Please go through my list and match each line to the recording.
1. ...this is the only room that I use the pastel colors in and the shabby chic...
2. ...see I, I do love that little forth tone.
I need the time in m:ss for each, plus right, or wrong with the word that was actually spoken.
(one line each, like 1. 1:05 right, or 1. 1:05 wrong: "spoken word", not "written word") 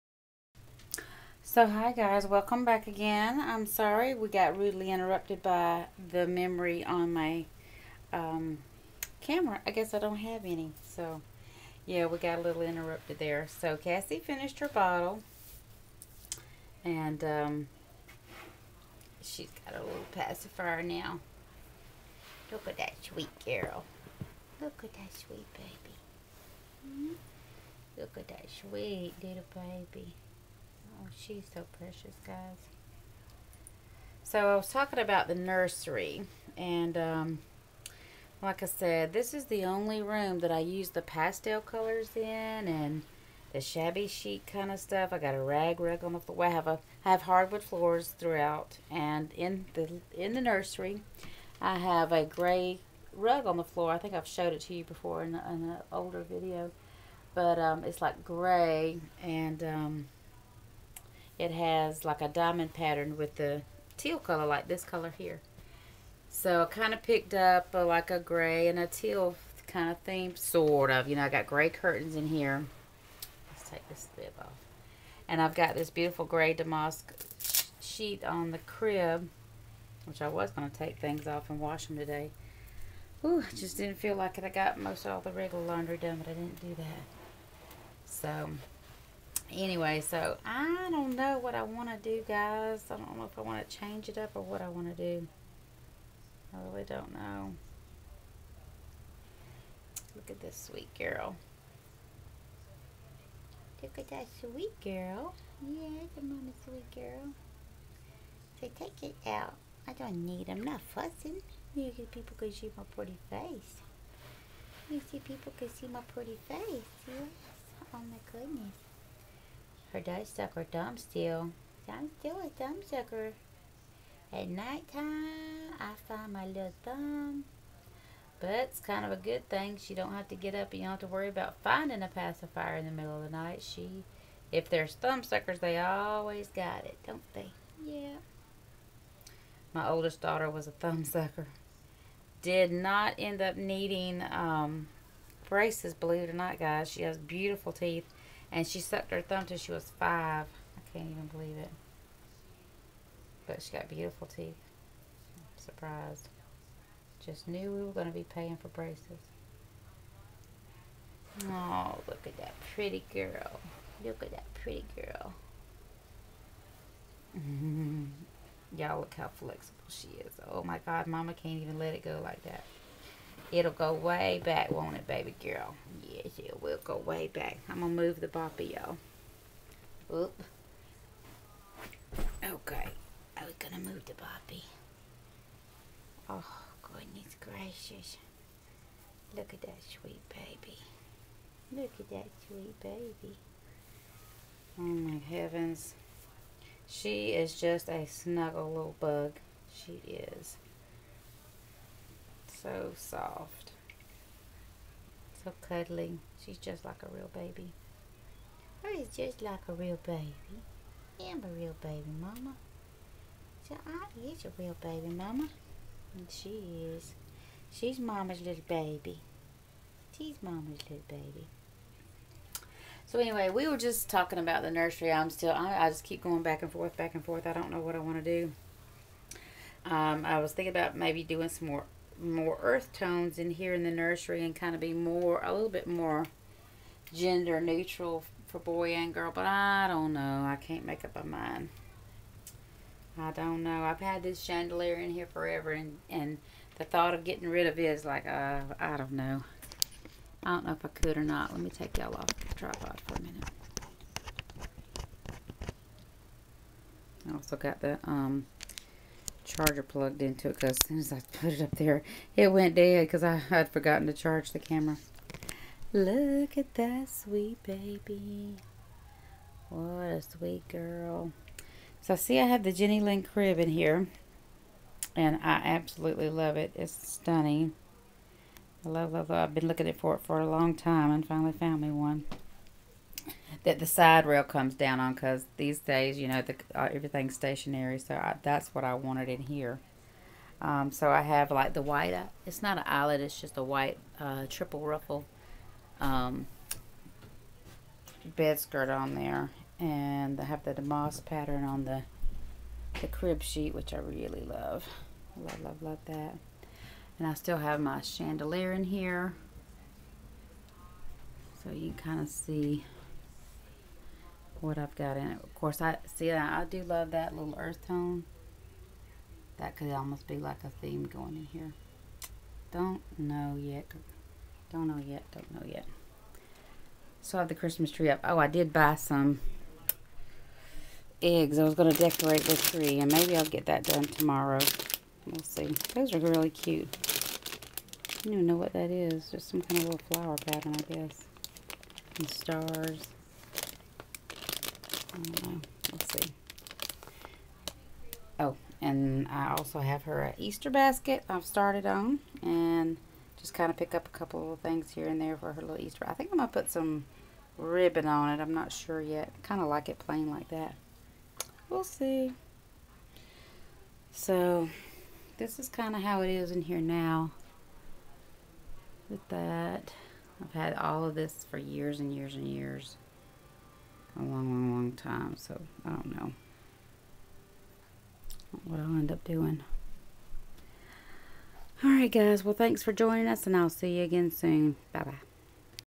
1. 0:39 right
2. 5:16 wrong: "earth", not "forth".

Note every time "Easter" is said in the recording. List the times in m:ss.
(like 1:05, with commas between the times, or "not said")
5:50, 5:55.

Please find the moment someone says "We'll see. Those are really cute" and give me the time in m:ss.
5:35.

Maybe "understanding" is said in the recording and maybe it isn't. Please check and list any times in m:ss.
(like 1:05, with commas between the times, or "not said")
not said.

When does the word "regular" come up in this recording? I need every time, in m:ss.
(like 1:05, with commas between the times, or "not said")
1:25.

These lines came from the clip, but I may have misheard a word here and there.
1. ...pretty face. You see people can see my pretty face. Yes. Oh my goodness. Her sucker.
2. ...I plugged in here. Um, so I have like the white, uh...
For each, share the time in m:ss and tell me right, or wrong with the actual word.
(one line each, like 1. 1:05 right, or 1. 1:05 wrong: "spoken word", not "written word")
1. 1:52 right
2. 4:48 wrong: "wanted", not "plugged".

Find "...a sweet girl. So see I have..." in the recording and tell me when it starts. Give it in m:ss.
4:30.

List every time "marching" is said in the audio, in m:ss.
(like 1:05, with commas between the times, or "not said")
not said.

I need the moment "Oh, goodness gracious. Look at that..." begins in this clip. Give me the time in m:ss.
3:06.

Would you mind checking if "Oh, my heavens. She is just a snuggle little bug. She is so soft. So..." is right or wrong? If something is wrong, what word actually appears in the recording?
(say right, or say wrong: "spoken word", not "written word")
right.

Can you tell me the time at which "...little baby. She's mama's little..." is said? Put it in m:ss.
3:38.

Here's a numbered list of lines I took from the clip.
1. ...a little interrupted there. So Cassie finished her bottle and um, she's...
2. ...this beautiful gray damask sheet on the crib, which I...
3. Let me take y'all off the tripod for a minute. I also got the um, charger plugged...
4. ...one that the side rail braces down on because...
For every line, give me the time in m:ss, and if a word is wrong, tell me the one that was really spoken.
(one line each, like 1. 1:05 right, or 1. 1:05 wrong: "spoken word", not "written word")
1. 0:12 right
2. 1:15 right
3. 4:11 right
4. 4:41 wrong: "comes", not "braces".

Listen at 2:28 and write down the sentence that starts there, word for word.
And she sucked her thumb till she was five.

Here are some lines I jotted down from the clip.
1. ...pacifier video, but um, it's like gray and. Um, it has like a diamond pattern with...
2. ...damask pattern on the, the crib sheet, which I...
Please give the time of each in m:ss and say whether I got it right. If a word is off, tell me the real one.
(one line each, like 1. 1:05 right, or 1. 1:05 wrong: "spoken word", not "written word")
1. 0:55 wrong: "older", not "pacifier"
2. 5:00 right.